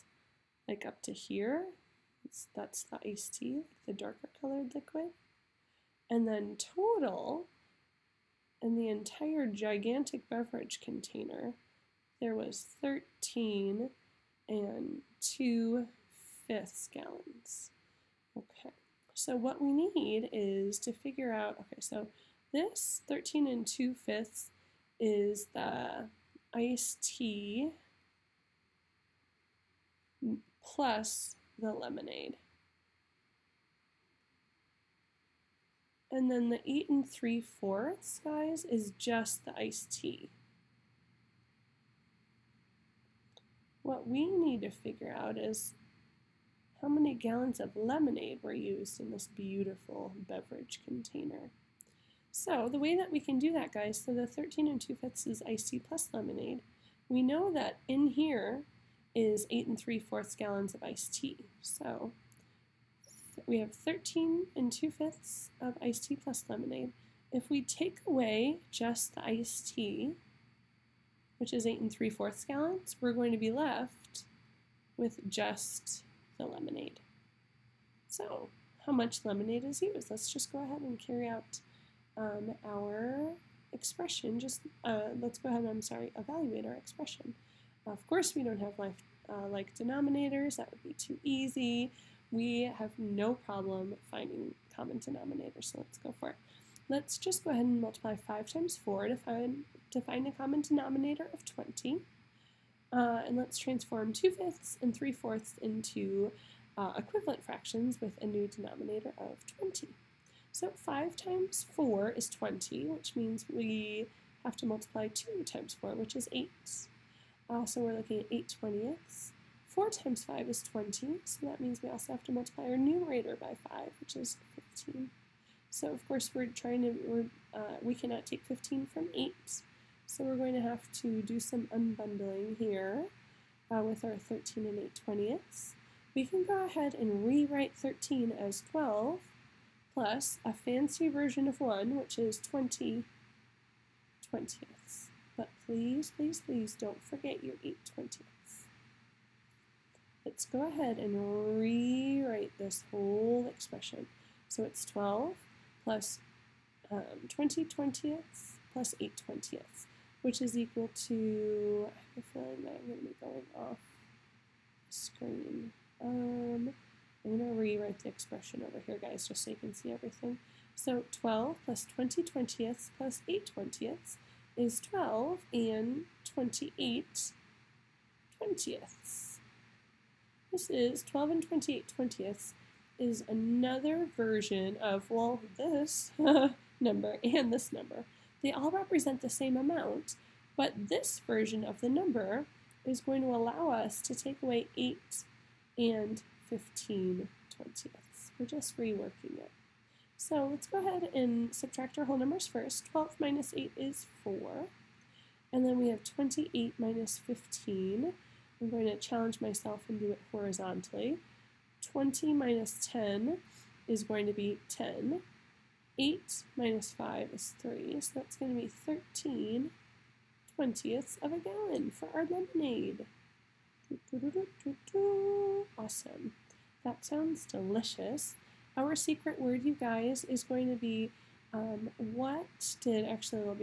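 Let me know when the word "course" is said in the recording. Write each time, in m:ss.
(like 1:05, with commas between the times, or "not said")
1:28, 2:06.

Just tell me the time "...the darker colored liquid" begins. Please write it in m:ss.
0:03.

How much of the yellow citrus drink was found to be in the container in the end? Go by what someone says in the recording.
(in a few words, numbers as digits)
4 13/20 gallons.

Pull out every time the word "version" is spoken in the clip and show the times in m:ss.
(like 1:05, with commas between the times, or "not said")
2:21, 3:04, 3:11.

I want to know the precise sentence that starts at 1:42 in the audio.
Uh, and let's transform 2 fifths and 3 fourths into uh, equivalent fractions with a new denominator of 20.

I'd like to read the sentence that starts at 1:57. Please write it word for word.
Uh, so we're looking at 8 twentieths.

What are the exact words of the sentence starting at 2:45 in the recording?
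Um, rewrite the expression over here, guys, just so you can see everything.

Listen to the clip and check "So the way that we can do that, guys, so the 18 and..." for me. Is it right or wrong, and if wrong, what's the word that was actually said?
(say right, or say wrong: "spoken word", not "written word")
wrong: "13", not "18".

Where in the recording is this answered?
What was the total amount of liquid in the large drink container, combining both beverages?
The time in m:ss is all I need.
0:12.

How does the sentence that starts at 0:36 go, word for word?
And then the 8 and 3 fourths, guys, is just the iced tea.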